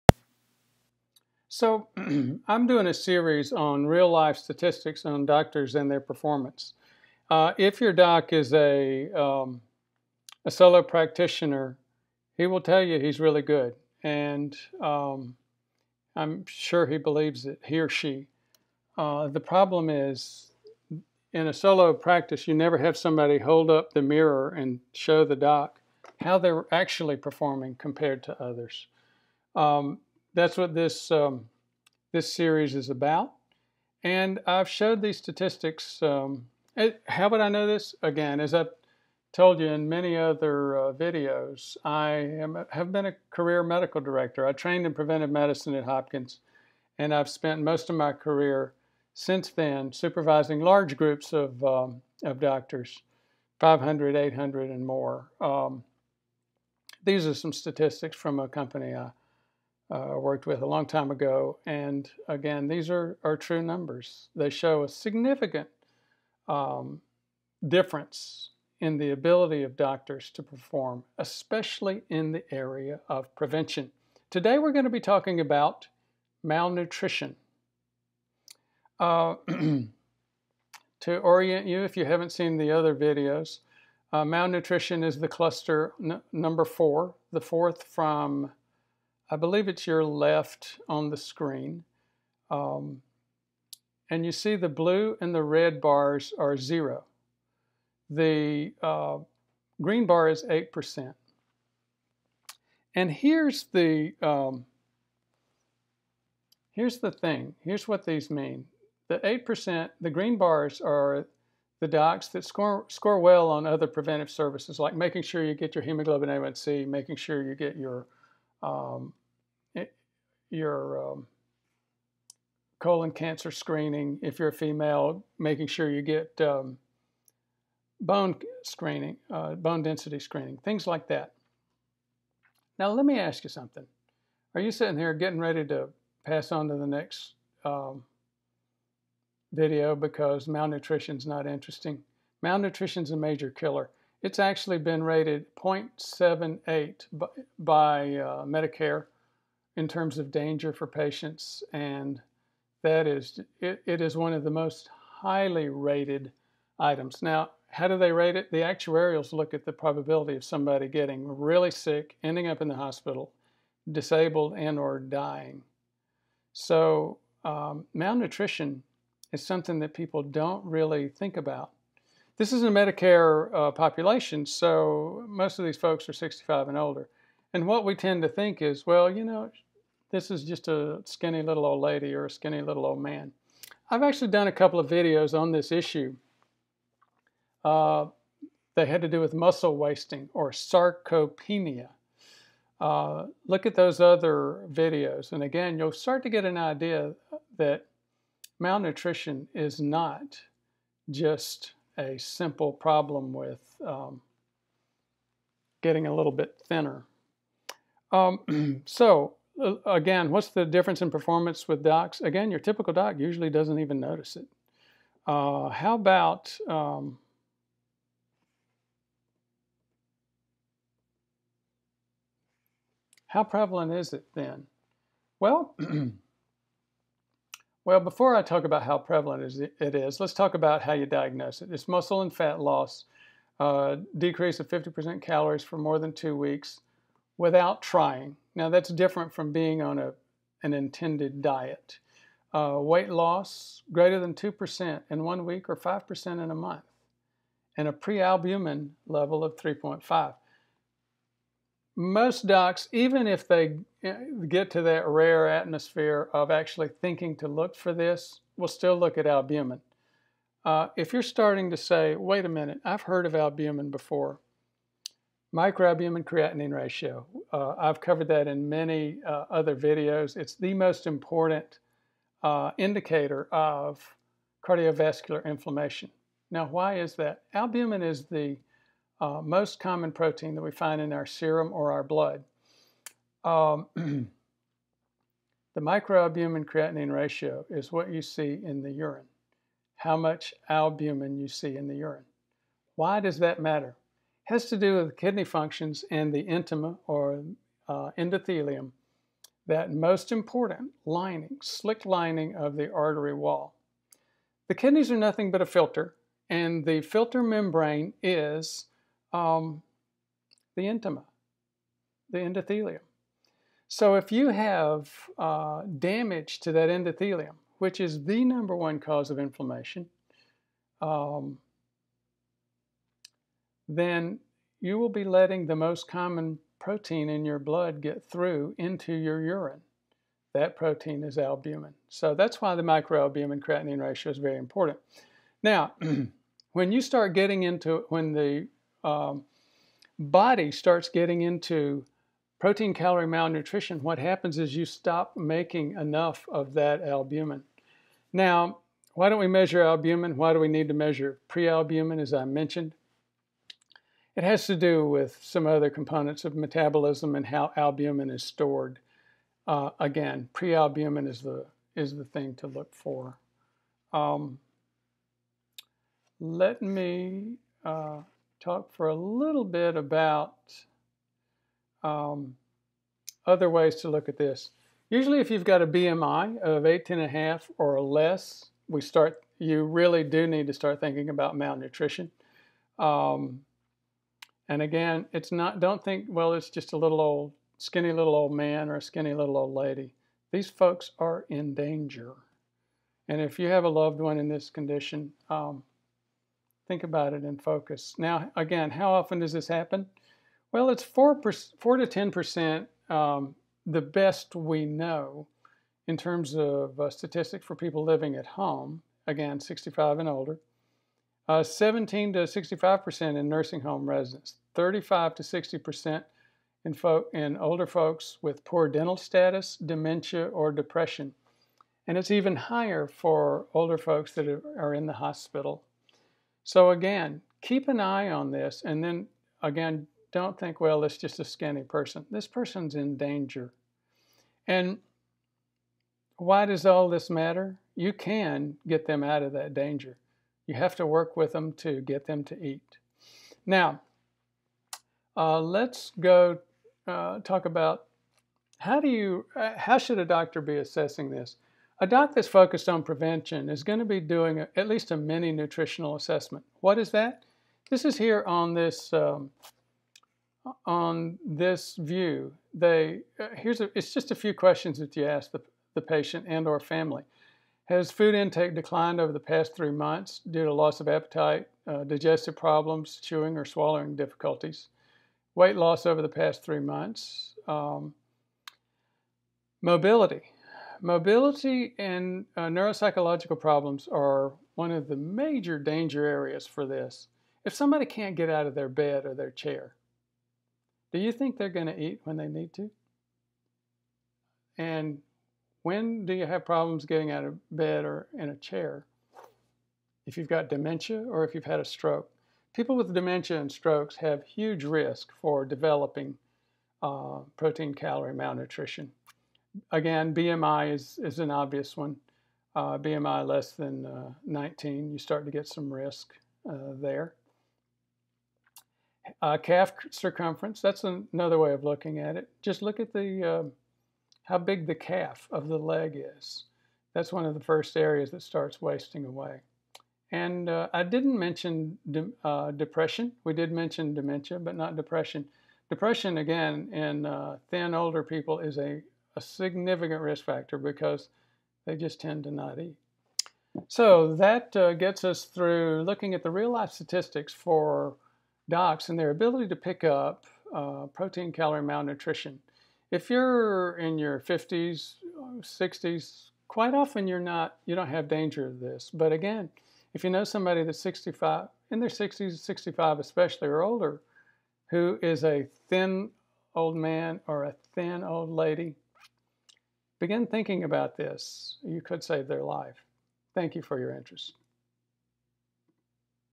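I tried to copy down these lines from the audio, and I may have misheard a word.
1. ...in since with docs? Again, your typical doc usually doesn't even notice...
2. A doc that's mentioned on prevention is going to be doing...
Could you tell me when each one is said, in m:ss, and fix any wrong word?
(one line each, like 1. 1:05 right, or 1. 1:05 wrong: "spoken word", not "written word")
1. 3:31 wrong: "performance", not "since"
2. 7:31 wrong: "focused", not "mentioned".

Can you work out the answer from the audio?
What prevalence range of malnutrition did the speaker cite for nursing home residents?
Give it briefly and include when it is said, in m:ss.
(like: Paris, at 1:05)
17 to 65%, at 6:51.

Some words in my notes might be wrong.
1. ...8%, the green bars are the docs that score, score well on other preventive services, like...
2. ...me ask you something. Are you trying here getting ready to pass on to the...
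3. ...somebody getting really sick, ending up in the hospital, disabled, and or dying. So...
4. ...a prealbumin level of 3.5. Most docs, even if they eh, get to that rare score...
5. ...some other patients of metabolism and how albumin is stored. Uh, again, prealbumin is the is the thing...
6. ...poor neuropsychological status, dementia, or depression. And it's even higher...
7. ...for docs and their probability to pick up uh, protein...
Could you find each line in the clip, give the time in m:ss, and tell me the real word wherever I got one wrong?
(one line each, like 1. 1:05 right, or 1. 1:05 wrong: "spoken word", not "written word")
1. 1:49 right
2. 2:13 wrong: "sitting", not "trying"
3. 2:40 right
4. 4:07 wrong: "atmosphere", not "score"
5. 5:55 wrong: "components", not "patients"
6. 6:58 wrong: "dental", not "neuropsychological"
7. 9:07 wrong: "ability", not "probability".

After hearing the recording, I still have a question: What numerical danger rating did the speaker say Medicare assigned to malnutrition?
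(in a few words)
0.78.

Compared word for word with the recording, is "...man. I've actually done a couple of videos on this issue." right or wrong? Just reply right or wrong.
right.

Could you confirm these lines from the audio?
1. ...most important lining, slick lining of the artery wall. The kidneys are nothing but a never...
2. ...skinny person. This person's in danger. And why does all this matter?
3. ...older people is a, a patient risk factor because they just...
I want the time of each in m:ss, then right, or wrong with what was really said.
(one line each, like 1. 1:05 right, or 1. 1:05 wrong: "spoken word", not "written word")
1. 4:59 wrong: "filter", not "never"
2. 7:11 right
3. 8:57 wrong: "significant", not "patient".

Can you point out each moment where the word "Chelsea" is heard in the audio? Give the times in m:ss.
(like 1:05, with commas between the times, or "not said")
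not said.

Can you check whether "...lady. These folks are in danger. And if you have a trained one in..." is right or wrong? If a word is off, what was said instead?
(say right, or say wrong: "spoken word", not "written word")
wrong: "loved", not "trained".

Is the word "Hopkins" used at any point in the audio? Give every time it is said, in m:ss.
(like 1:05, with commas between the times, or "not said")
0:45.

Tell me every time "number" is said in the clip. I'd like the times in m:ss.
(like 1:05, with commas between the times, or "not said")
1:03, 1:26, 5:18.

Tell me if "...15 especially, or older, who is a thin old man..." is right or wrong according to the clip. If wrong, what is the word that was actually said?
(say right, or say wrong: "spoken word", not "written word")
wrong: "65", not "15".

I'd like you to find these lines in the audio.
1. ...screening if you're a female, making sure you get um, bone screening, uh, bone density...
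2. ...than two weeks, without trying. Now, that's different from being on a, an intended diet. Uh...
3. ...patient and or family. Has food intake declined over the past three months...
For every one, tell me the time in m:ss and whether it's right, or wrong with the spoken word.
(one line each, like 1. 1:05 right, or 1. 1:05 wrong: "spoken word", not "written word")
1. 2:03 right
2. 3:55 right
3. 7:46 right.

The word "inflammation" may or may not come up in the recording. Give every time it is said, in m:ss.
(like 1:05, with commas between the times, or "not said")
4:35, 5:19.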